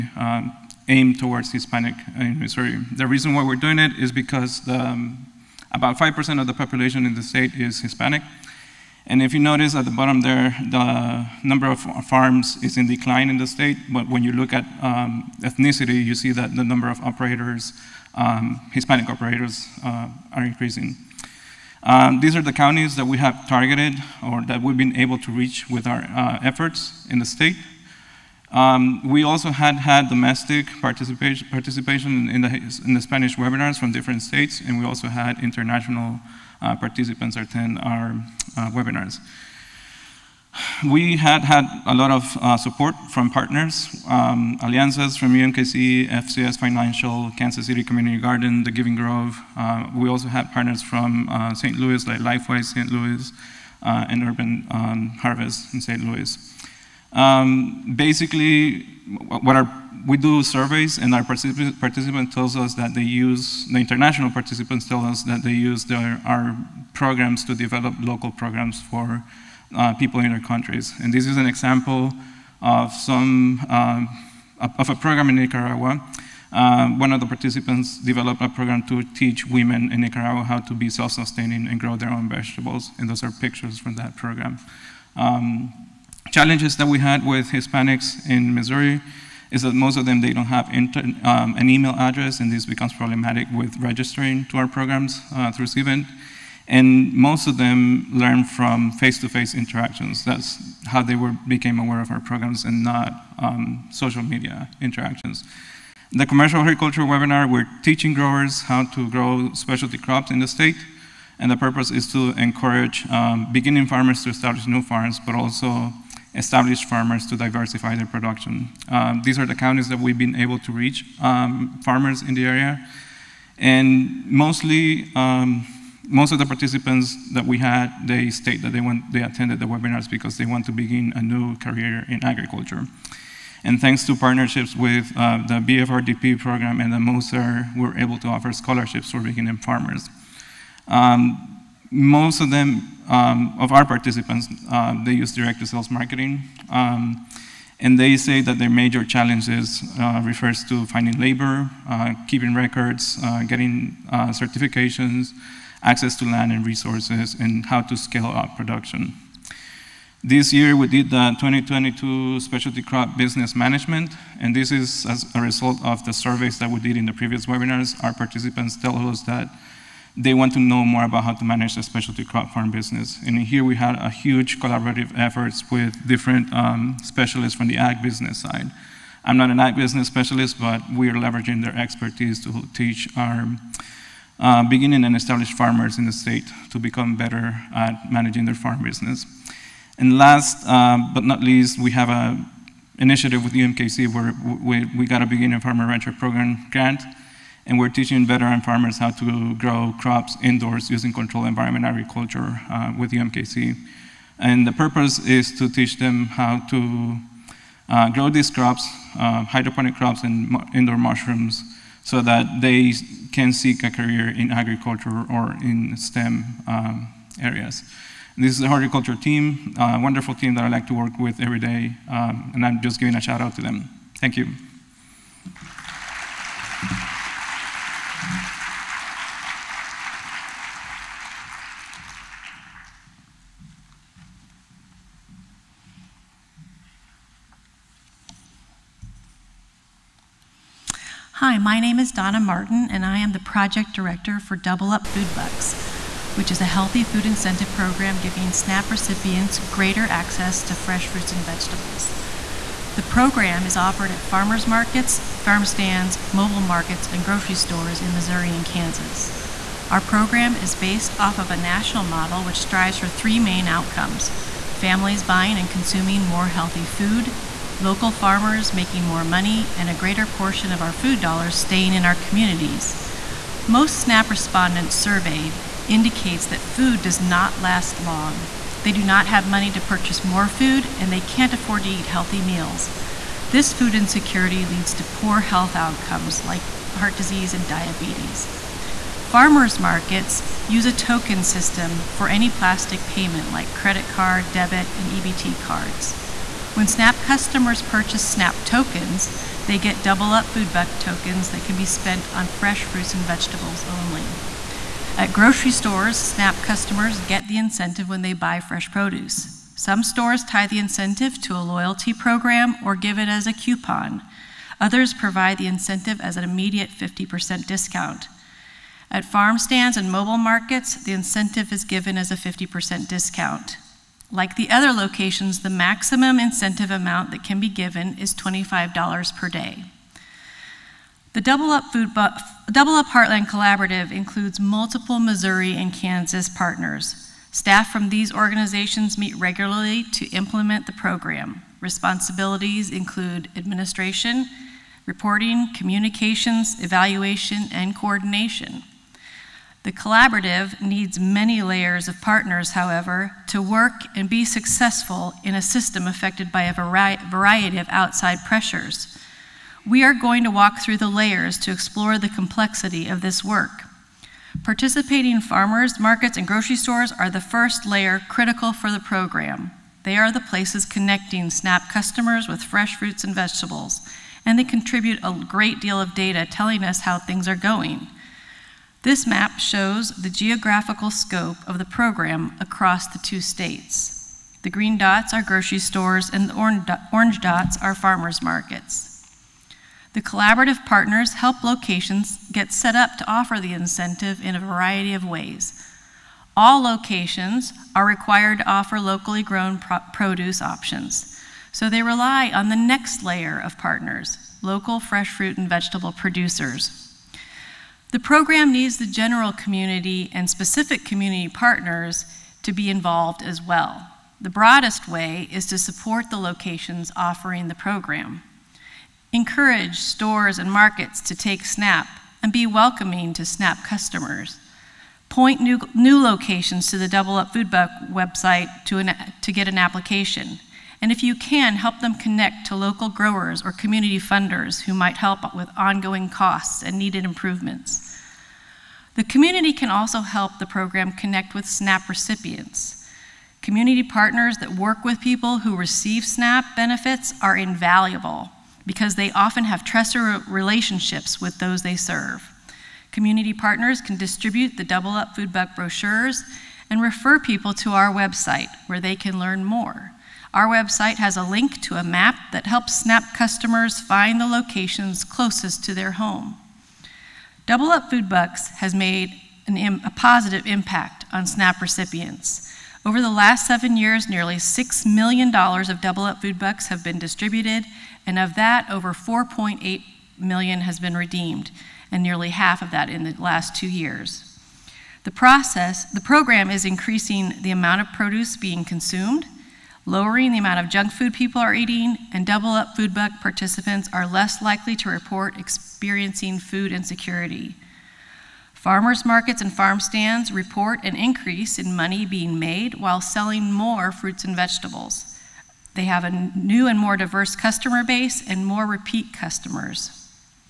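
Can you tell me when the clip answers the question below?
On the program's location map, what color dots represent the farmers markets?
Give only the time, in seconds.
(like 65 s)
387 s.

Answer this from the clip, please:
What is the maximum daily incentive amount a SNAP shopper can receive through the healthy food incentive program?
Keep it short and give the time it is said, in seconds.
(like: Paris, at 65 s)
$25, at 328 s.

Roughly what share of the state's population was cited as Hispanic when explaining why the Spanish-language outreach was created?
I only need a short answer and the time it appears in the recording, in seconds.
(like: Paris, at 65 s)
5%, at 5 s.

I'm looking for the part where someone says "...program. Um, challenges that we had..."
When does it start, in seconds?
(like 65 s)
84 s.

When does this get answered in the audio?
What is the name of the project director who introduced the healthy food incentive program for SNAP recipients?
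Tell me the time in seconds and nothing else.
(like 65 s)
242 s.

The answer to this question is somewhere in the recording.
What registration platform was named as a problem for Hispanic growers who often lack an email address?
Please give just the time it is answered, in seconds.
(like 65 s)
95 s.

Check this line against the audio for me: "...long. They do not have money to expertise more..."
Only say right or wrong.
wrong.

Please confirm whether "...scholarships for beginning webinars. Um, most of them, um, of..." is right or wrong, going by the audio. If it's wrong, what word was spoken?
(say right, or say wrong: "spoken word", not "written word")
wrong: "farmers", not "webinars".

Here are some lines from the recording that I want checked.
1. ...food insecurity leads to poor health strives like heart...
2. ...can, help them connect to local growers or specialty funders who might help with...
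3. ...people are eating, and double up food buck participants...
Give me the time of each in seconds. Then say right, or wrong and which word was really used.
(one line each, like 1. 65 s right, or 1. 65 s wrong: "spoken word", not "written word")
1. 283 s wrong: "outcomes", not "strives"
2. 431 s wrong: "community", not "specialty"
3. 491 s right.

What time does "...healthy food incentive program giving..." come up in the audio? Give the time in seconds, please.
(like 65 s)
246 s.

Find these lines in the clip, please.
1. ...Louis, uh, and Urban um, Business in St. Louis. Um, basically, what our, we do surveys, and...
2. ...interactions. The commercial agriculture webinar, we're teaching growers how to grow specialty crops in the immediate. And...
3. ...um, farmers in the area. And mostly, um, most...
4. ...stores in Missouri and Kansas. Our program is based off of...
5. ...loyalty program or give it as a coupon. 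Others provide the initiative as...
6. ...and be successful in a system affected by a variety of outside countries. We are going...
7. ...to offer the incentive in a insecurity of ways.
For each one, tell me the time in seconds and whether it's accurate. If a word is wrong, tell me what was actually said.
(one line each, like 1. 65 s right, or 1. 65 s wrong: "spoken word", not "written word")
1. 52 s wrong: "Harvest", not "Business"
2. 104 s wrong: "state", not "immediate"
3. 121 s right
4. 257 s right
5. 311 s wrong: "incentive", not "initiative"
6. 354 s wrong: "pressures", not "countries"
7. 393 s wrong: "variety", not "insecurity".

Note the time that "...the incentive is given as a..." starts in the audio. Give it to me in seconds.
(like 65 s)
321 s.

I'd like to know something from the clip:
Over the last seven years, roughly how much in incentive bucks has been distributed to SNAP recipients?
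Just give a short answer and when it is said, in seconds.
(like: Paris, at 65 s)
nearly $6 million, at 474 s.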